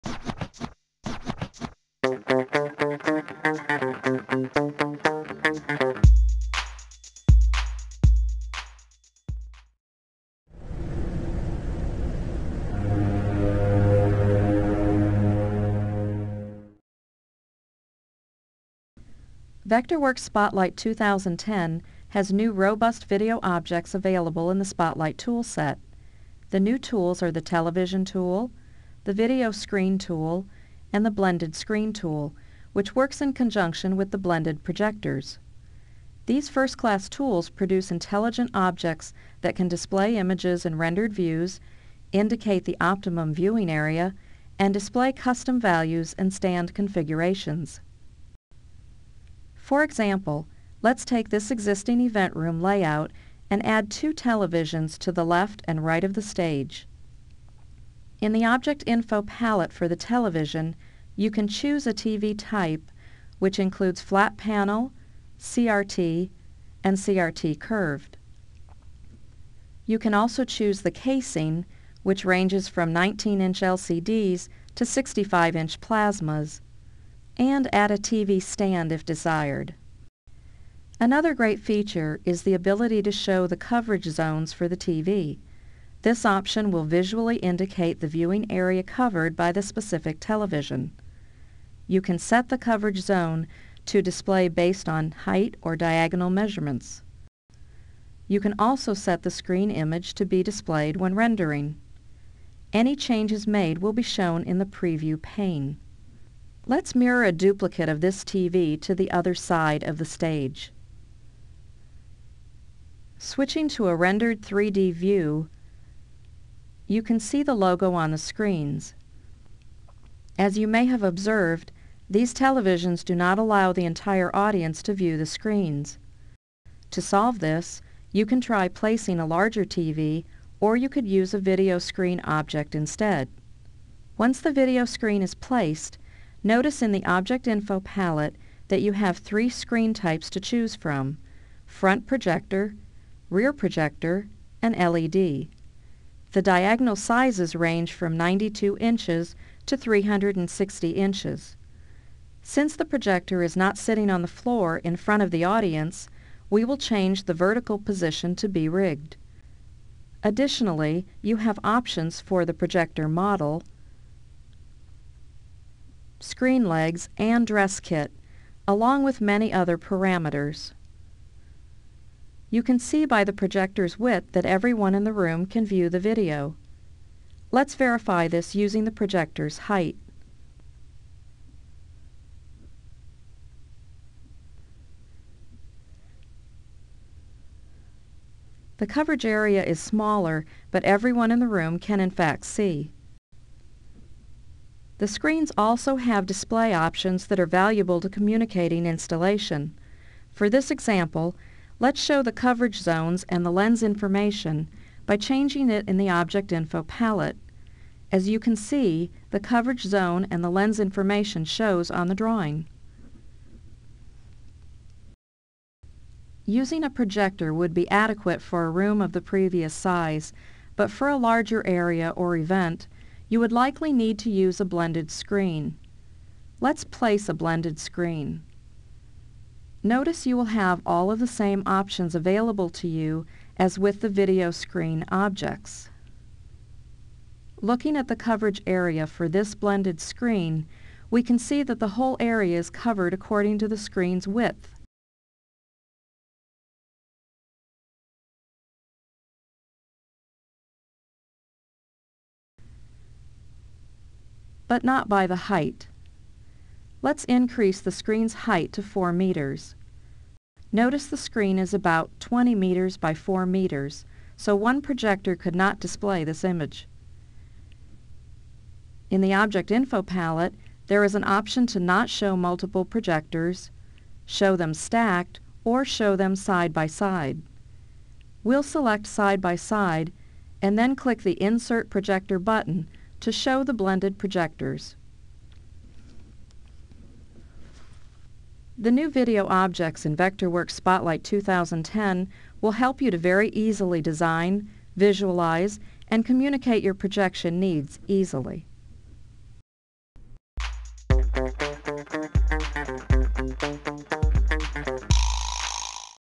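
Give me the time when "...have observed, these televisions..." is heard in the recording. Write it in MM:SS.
02:00.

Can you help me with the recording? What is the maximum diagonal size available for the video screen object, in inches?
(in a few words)
360 inches.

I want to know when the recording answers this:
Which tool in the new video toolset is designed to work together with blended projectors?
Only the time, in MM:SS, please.
00:31.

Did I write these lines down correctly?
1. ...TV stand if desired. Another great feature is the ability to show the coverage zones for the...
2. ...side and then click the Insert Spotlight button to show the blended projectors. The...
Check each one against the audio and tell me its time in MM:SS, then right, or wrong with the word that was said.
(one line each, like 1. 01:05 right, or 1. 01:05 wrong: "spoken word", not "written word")
1. 01:17 right
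2. 04:39 wrong: "Projector", not "Spotlight".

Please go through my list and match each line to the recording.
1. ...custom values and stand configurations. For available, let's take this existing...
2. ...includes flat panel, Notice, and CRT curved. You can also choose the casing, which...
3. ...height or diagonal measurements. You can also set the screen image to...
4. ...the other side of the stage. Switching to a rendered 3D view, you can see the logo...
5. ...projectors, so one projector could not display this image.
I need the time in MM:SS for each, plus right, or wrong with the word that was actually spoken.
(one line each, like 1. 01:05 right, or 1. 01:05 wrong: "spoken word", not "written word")
1. 00:45 wrong: "example", not "available"
2. 01:03 wrong: "CRT", not "Notice"
3. 01:35 right
4. 01:48 right
5. 04:23 wrong: "meters", not "projectors".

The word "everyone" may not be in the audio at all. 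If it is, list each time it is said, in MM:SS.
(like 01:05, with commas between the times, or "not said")
02:54, 03:10.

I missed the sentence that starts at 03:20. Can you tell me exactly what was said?
For this example, let's show the coverage zones and the lens information by changing it in the Object Info palette.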